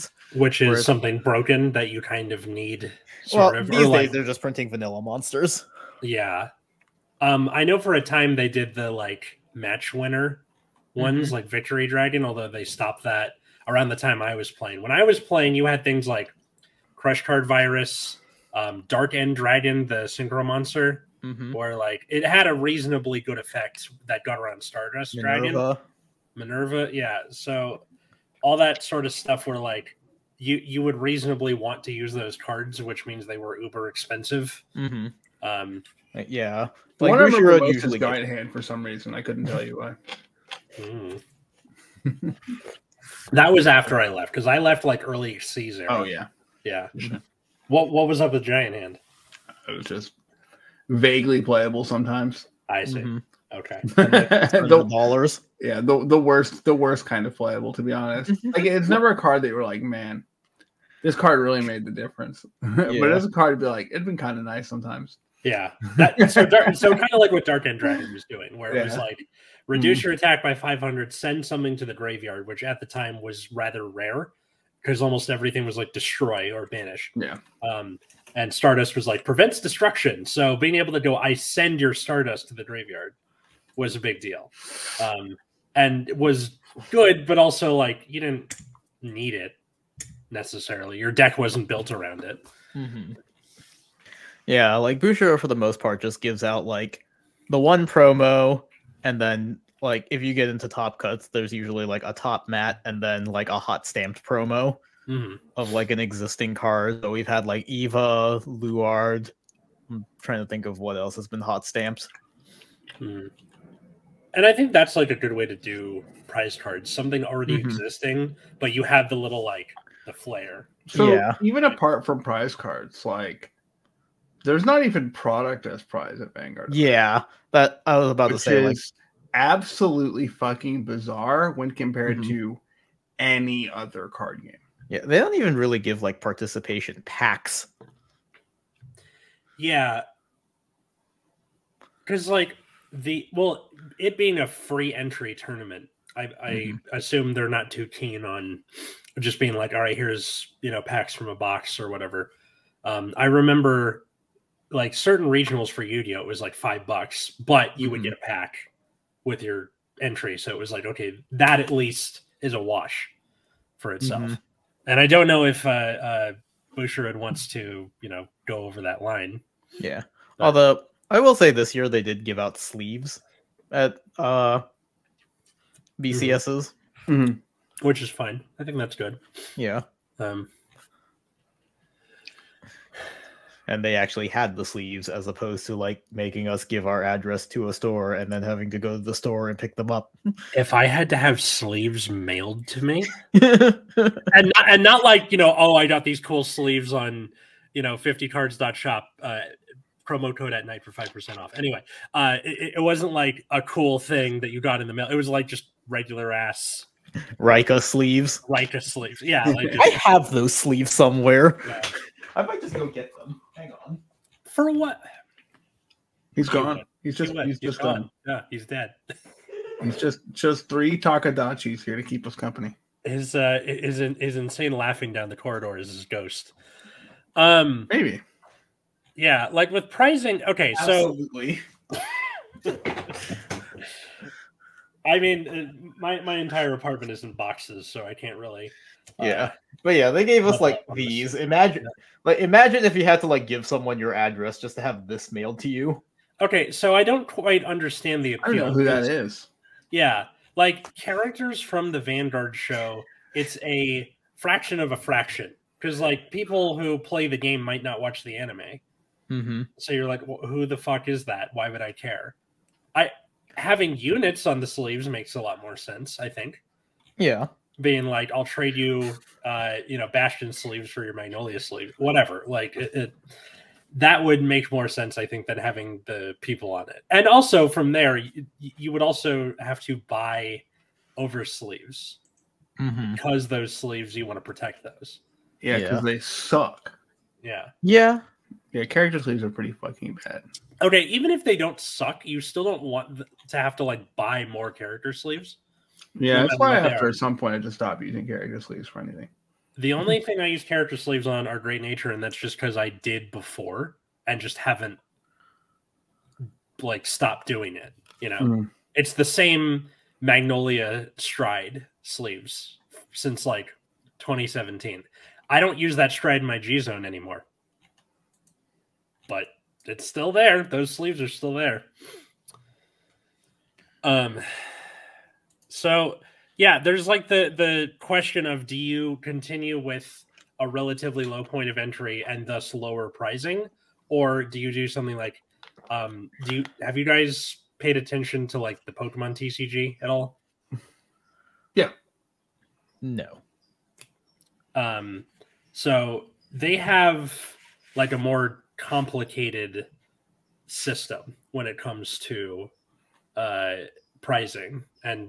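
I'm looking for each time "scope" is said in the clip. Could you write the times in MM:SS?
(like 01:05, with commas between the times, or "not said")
not said.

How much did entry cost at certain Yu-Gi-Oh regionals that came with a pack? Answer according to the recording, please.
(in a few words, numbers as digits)
5 bucks.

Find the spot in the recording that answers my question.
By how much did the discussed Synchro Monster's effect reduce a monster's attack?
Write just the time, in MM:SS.
01:10.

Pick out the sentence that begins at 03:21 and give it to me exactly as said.
Anyway, uh, it, it, wasn't like a cool thing that you got in the mail.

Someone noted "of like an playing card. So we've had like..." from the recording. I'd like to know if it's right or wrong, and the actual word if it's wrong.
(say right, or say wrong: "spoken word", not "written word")
wrong: "existing", not "playing".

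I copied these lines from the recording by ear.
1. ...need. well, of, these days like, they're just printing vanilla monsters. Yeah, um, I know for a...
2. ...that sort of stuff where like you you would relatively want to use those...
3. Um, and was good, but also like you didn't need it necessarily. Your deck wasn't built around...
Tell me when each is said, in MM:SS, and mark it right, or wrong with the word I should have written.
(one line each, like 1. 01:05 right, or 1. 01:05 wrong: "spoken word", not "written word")
1. 00:02 right
2. 00:28 wrong: "reasonably", not "relatively"
3. 01:25 right.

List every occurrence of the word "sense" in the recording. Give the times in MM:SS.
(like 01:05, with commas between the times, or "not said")
04:25, 04:34.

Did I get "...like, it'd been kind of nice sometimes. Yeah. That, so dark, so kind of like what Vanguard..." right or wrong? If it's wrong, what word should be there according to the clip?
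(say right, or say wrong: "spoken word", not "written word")
wrong: "Dark", not "Vanguard".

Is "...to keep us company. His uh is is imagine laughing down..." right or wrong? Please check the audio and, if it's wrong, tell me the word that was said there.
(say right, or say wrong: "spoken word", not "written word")
wrong: "insane", not "imagine".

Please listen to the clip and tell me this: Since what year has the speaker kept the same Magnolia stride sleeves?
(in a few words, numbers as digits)
2017.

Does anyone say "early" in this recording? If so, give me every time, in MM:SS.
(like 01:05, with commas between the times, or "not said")
00:45.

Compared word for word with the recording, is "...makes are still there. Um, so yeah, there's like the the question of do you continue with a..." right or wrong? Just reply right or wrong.
wrong.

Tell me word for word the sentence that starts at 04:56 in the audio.
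Yeah, that's why after some point I just stopped using character sleeves for anything.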